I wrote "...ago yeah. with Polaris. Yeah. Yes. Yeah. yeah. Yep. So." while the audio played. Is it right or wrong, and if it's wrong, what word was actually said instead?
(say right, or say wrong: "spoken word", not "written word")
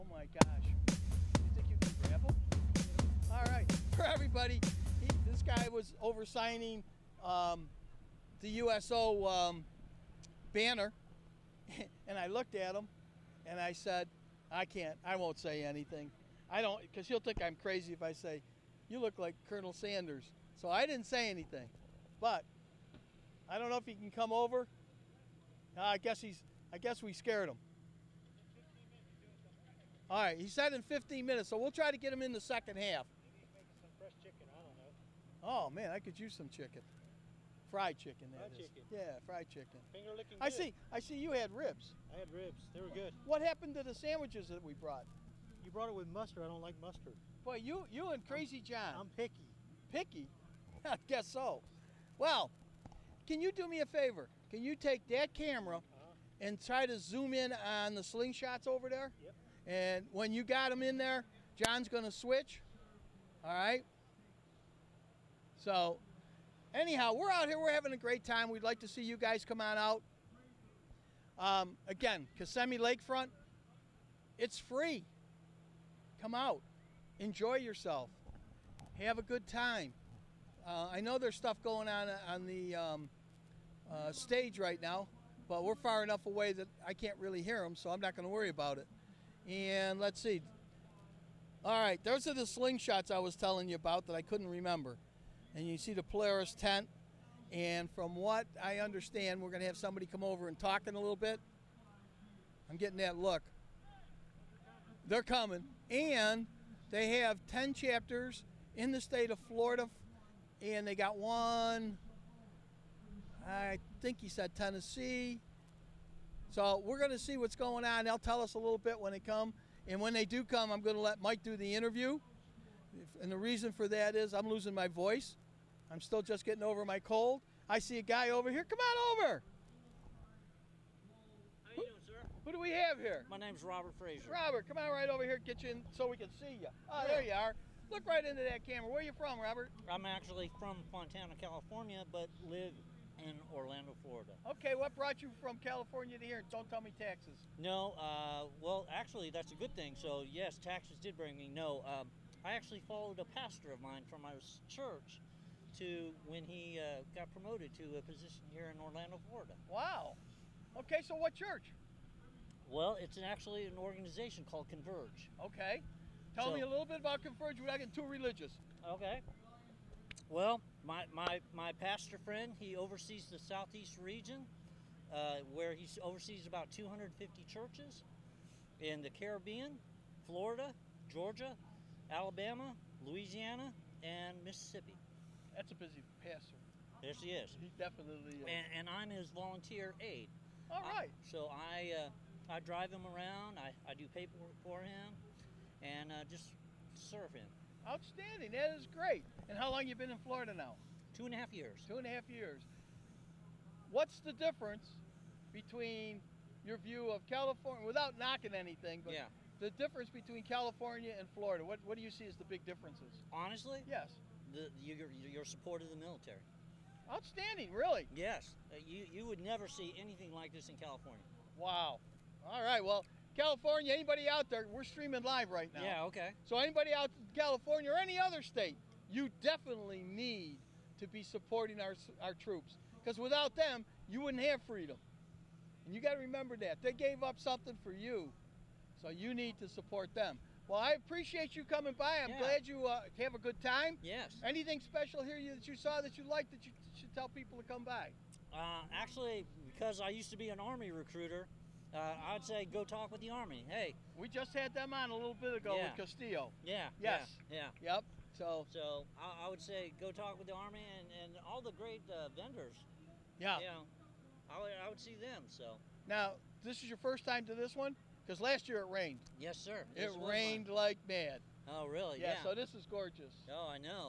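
wrong: "Castillo", not "Polaris".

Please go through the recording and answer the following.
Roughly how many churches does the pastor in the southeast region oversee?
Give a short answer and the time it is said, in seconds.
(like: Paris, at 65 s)
250, at 176 s.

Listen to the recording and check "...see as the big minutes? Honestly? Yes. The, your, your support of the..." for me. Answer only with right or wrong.
wrong.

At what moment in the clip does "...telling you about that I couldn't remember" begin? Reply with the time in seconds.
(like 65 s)
93 s.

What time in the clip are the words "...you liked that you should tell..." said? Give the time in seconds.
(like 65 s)
246 s.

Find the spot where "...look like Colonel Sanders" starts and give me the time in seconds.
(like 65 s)
18 s.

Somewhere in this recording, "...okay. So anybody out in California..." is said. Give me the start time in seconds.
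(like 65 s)
226 s.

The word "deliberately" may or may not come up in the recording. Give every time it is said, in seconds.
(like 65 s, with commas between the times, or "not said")
not said.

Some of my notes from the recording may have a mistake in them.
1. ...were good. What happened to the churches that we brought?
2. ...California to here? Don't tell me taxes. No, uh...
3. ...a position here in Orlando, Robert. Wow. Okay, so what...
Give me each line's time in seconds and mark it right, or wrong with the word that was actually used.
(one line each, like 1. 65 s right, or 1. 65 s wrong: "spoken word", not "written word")
1. 42 s wrong: "sandwiches", not "churches"
2. 145 s right
3. 157 s wrong: "Florida", not "Robert".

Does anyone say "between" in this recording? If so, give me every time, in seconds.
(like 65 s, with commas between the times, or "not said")
205 s, 210 s.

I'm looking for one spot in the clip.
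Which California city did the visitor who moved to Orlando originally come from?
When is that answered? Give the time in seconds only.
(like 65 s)
140 s.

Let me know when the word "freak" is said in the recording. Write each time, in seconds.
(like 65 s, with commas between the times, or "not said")
not said.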